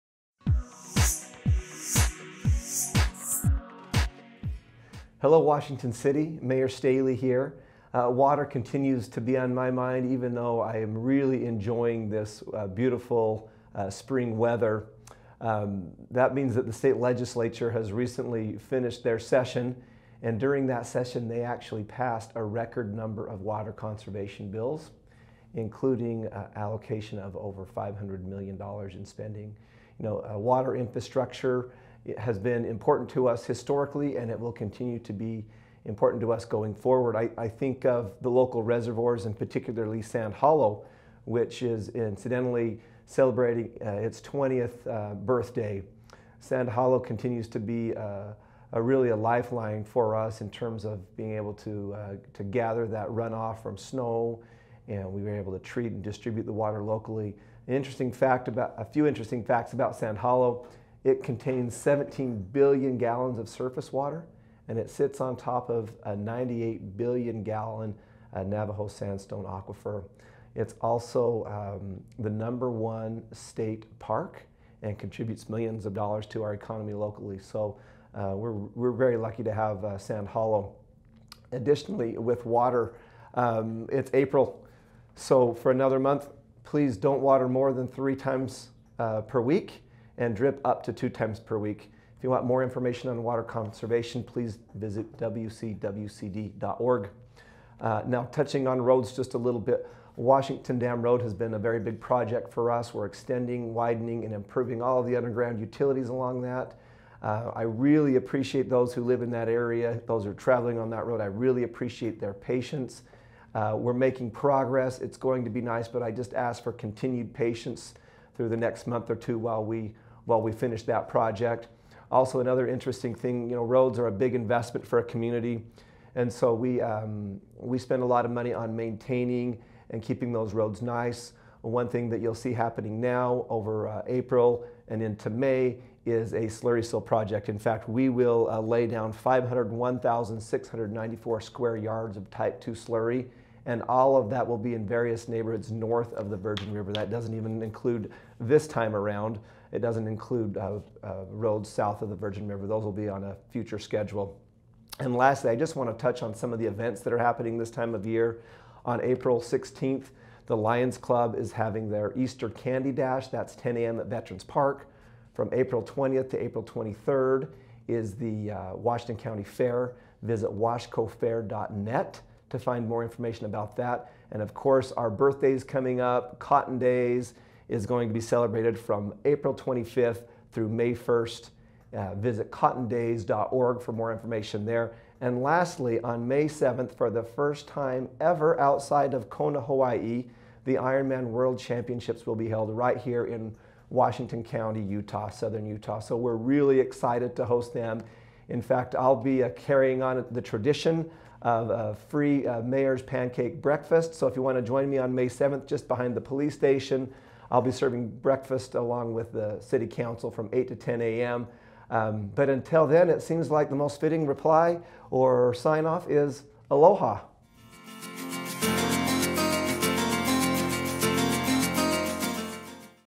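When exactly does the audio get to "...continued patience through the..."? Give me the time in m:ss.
1:56.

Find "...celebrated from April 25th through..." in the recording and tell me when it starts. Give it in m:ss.
2:58.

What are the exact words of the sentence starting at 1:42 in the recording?
We're extending, widening, and improving all of the underground utilities along that.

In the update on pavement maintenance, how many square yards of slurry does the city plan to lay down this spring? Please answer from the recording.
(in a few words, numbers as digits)
501,694.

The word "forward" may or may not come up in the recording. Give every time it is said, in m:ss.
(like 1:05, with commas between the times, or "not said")
0:36.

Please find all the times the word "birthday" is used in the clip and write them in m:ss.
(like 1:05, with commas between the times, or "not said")
0:45, 2:55.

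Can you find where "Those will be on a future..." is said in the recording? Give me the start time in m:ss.
2:32.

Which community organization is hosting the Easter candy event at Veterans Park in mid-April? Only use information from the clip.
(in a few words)
Lions Club.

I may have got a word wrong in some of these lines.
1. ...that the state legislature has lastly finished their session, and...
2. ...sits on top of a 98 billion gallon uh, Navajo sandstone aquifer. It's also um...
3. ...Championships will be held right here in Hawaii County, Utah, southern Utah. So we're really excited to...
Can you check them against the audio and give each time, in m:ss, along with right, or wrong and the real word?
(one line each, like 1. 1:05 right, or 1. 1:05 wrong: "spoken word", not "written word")
1. 0:16 wrong: "recently", not "lastly"
2. 1:04 right
3. 3:11 wrong: "Washington", not "Hawaii".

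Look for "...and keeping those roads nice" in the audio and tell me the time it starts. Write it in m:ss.
2:09.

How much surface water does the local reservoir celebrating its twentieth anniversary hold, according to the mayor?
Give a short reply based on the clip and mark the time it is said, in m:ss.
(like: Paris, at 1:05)
17 billion gallons, at 1:01.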